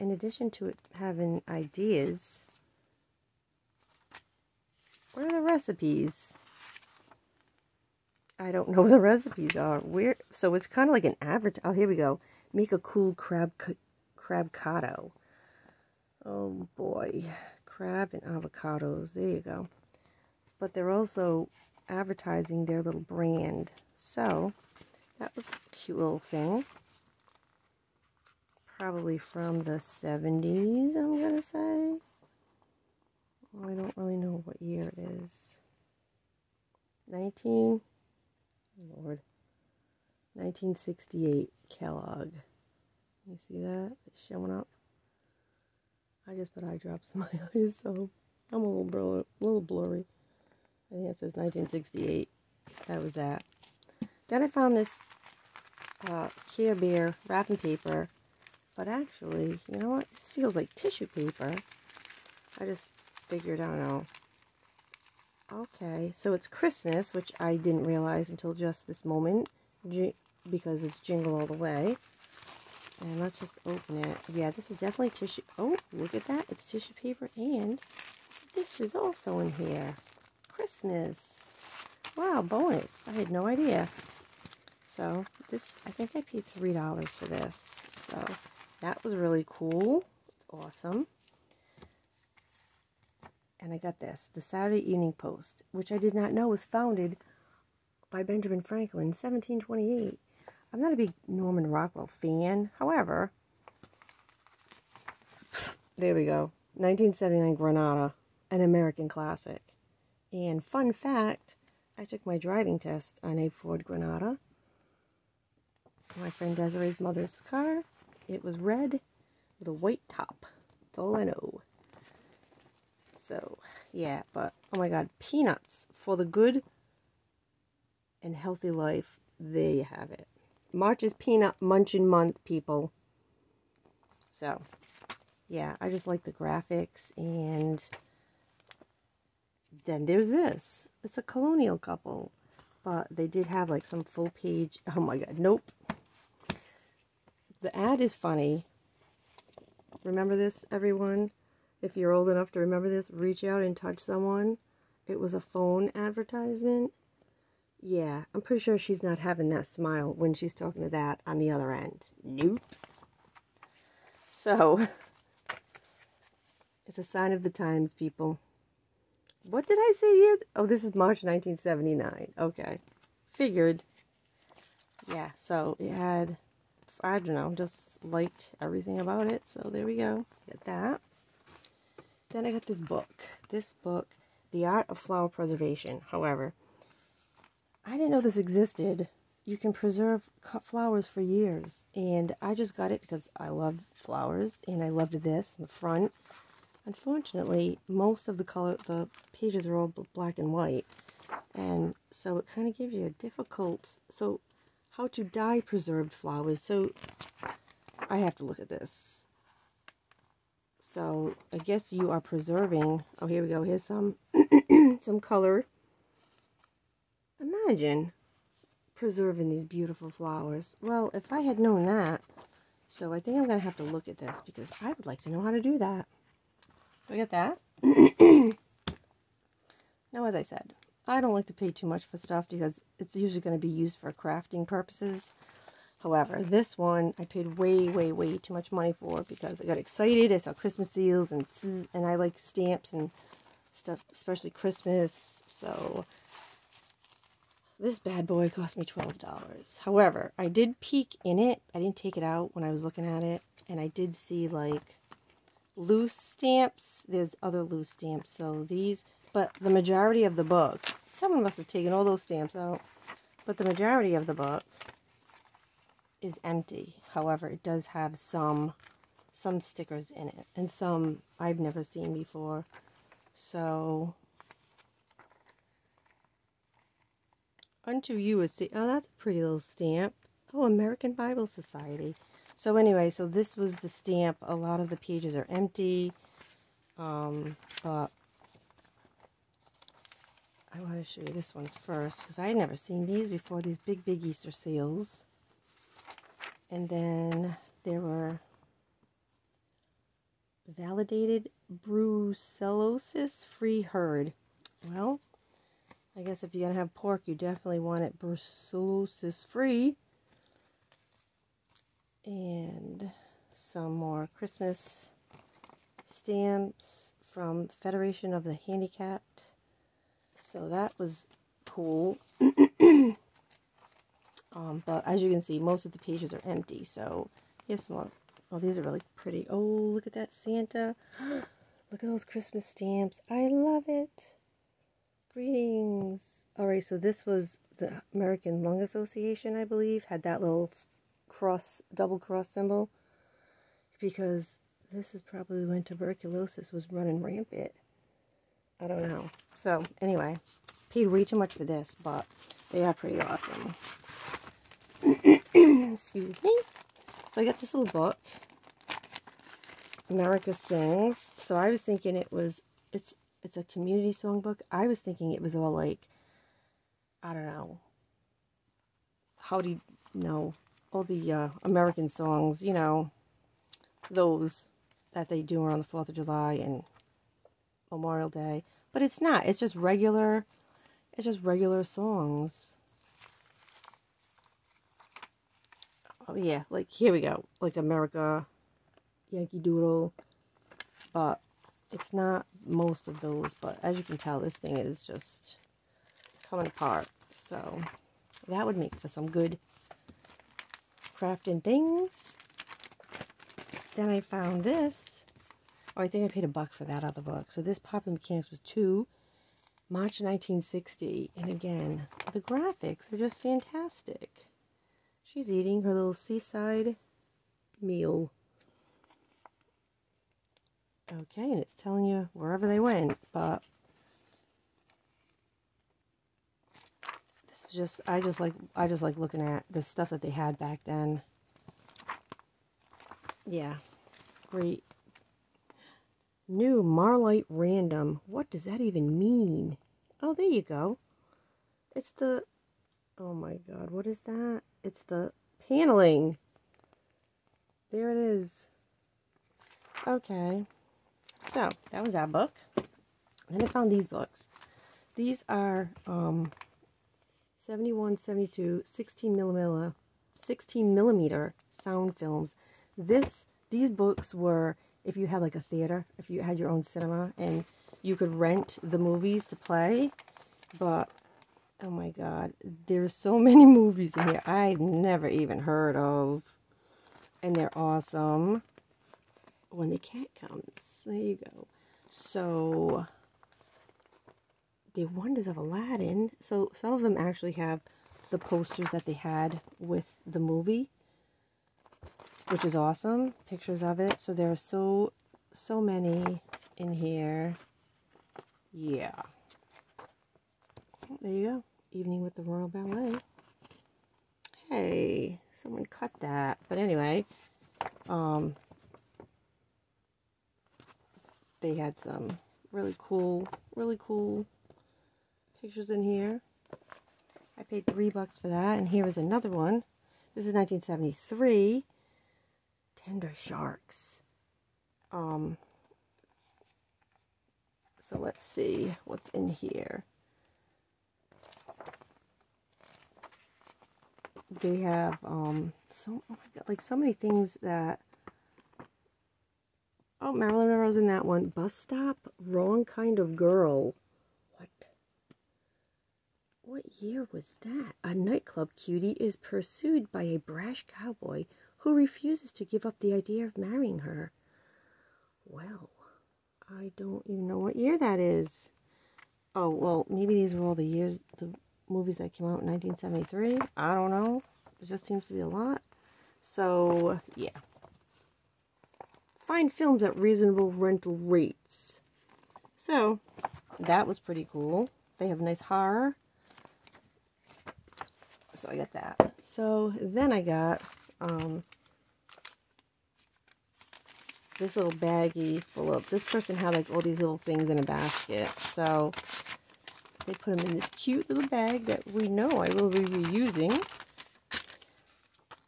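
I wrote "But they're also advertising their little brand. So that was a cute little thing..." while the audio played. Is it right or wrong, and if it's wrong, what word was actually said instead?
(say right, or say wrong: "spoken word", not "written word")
right.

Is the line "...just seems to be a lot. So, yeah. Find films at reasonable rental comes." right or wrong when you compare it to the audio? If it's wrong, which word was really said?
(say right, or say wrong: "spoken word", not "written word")
wrong: "rates", not "comes".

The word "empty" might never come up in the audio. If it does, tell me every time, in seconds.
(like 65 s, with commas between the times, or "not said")
266 s, 285 s, 326 s.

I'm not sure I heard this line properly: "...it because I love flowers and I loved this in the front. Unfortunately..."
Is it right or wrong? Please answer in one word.
right.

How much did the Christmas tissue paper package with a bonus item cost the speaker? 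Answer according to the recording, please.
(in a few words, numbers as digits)
$3.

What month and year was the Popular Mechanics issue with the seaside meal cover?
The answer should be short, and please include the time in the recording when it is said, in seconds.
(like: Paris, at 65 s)
March 1960, at 409 s.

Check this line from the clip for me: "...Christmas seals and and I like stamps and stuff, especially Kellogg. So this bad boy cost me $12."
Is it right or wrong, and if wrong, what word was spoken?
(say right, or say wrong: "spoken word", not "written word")
wrong: "Christmas", not "Kellogg".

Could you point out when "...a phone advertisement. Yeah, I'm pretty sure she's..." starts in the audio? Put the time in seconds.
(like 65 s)
155 s.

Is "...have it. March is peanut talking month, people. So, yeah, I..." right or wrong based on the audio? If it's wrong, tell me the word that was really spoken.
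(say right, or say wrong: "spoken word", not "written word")
wrong: "munching", not "talking".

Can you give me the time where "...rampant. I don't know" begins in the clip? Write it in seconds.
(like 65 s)
347 s.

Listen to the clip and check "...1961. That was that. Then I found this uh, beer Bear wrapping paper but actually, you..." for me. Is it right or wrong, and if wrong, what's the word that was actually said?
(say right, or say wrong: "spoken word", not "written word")
wrong: "1968", not "1961".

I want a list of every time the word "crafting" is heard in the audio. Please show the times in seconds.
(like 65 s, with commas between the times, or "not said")
234 s, 401 s.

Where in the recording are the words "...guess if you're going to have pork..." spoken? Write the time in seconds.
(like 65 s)
306 s.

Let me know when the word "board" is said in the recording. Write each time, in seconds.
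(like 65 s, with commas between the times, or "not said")
not said.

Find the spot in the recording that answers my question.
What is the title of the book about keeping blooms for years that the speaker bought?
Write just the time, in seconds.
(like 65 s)
184 s.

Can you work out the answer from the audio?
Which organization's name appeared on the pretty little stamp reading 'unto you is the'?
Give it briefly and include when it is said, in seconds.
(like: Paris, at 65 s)
American Bible Society, at 280 s.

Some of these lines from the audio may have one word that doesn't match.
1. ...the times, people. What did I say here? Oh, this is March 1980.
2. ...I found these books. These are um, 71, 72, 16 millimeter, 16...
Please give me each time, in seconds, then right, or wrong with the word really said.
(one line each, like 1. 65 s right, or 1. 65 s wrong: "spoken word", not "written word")
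1. 167 s wrong: "1979", not "1980"
2. 453 s right.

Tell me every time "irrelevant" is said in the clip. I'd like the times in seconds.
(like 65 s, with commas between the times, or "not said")
not said.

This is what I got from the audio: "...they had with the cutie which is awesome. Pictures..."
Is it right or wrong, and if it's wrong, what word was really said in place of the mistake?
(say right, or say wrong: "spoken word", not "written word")
wrong: "movie", not "cutie".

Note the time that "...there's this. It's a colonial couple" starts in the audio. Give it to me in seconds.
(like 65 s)
140 s.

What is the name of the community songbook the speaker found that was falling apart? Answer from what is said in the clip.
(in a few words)
America Sings.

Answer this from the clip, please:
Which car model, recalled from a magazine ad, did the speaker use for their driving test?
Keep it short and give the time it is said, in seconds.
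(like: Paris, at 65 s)
Ford Granada, at 113 s.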